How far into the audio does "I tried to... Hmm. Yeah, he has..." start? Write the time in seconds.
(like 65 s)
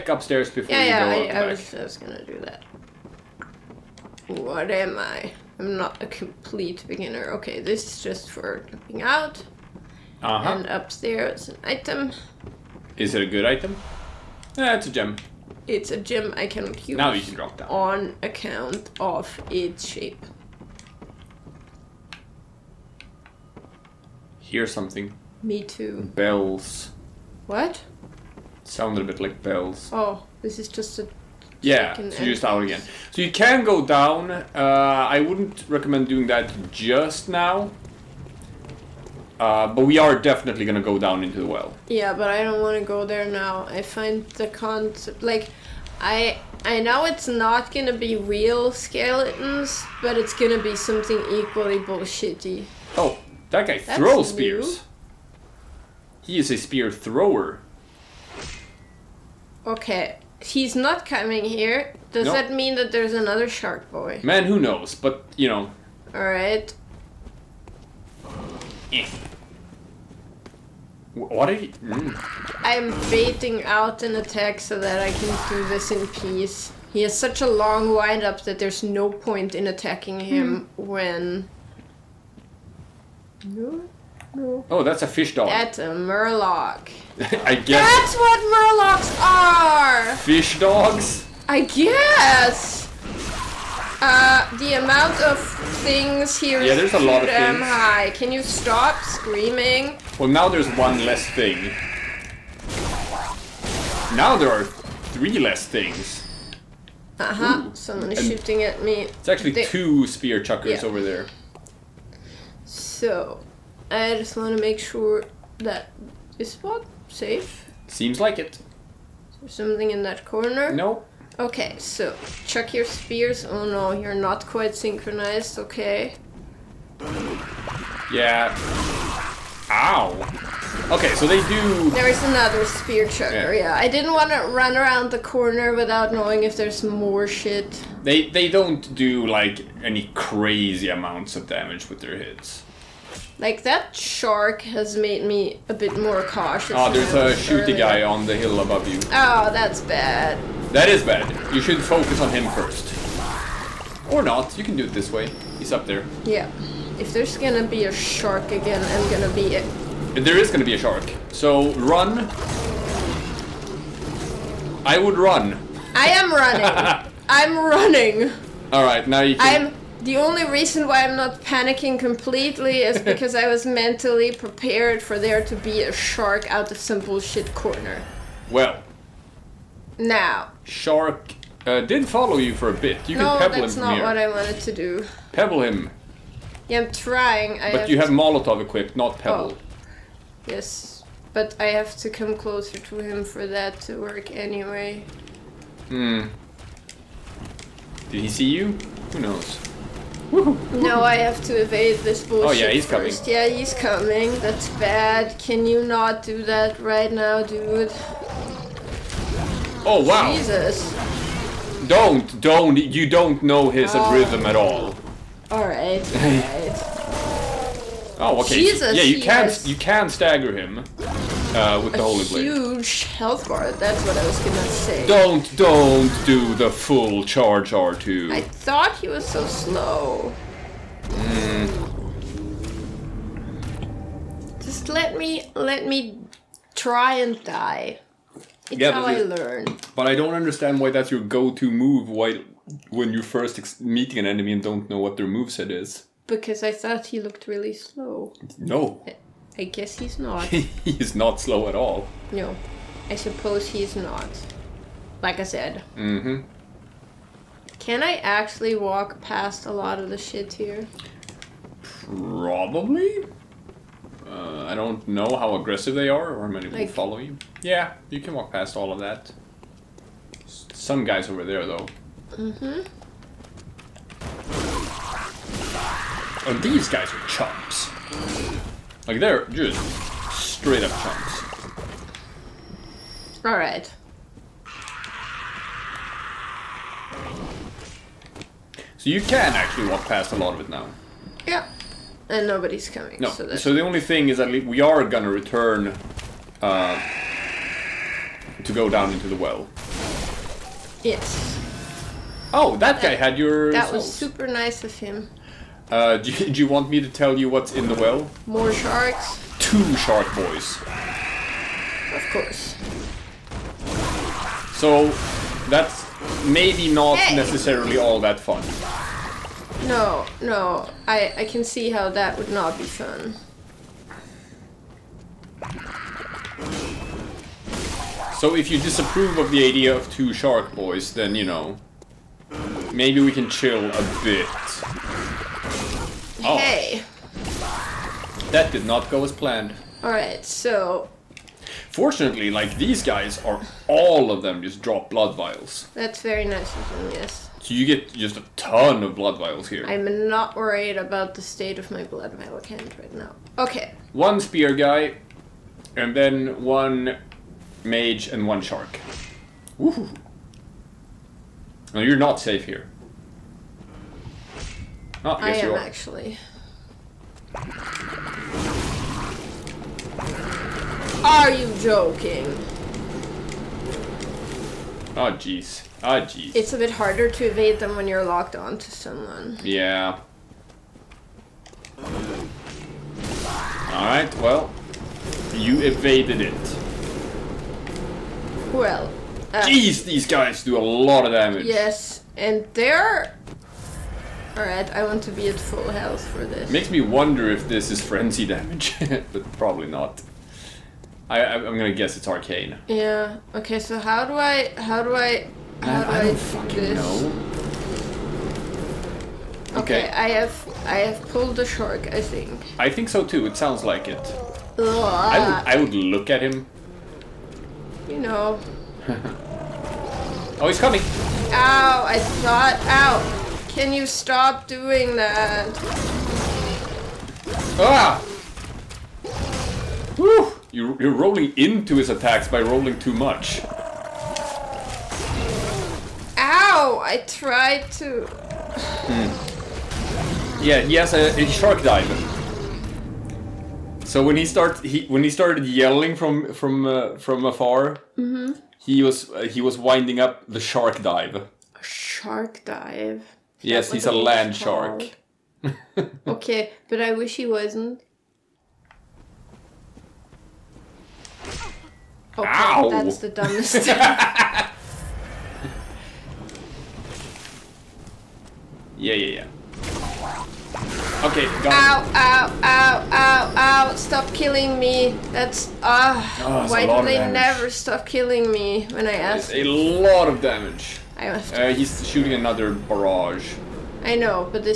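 437 s.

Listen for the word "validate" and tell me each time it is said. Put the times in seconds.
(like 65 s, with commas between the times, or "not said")
not said.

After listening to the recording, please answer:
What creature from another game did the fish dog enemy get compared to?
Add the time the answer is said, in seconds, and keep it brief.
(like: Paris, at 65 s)
murloc, at 85 s.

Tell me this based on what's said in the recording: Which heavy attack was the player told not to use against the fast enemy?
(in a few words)
full charge R2.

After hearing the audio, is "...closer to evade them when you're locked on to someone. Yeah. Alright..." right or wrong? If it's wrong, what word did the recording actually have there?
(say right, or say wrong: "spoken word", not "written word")
wrong: "harder", not "closer".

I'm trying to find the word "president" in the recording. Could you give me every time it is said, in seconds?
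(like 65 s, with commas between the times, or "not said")
not said.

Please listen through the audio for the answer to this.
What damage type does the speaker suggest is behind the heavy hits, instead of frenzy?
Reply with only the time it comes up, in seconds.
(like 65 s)
402 s.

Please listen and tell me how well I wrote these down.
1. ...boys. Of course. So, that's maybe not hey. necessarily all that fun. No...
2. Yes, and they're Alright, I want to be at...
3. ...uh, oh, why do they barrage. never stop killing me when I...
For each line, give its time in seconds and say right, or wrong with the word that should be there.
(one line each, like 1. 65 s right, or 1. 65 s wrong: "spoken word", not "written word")
1. 310 s right
2. 391 s right
3. 476 s wrong: "damage", not "barrage".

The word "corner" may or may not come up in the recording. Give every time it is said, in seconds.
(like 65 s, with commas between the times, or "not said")
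120 s, 135 s, 177 s.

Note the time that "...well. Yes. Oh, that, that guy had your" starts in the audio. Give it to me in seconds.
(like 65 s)
299 s.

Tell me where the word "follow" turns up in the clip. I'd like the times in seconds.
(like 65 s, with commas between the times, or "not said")
182 s, 266 s.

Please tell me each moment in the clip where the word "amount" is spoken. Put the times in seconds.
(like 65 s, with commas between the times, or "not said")
94 s, 140 s.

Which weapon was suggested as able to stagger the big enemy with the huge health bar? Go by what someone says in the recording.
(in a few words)
Holy Blade.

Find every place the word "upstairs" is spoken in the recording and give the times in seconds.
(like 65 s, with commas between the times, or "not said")
0 s, 10 s.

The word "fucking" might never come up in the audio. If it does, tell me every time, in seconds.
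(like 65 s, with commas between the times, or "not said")
406 s.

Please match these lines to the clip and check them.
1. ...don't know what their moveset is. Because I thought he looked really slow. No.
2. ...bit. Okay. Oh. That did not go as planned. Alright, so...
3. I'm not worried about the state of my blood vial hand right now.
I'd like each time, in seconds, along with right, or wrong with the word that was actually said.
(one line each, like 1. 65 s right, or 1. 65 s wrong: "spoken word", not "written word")
1. 244 s right
2. 334 s right
3. 349 s right.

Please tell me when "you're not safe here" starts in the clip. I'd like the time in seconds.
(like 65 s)
361 s.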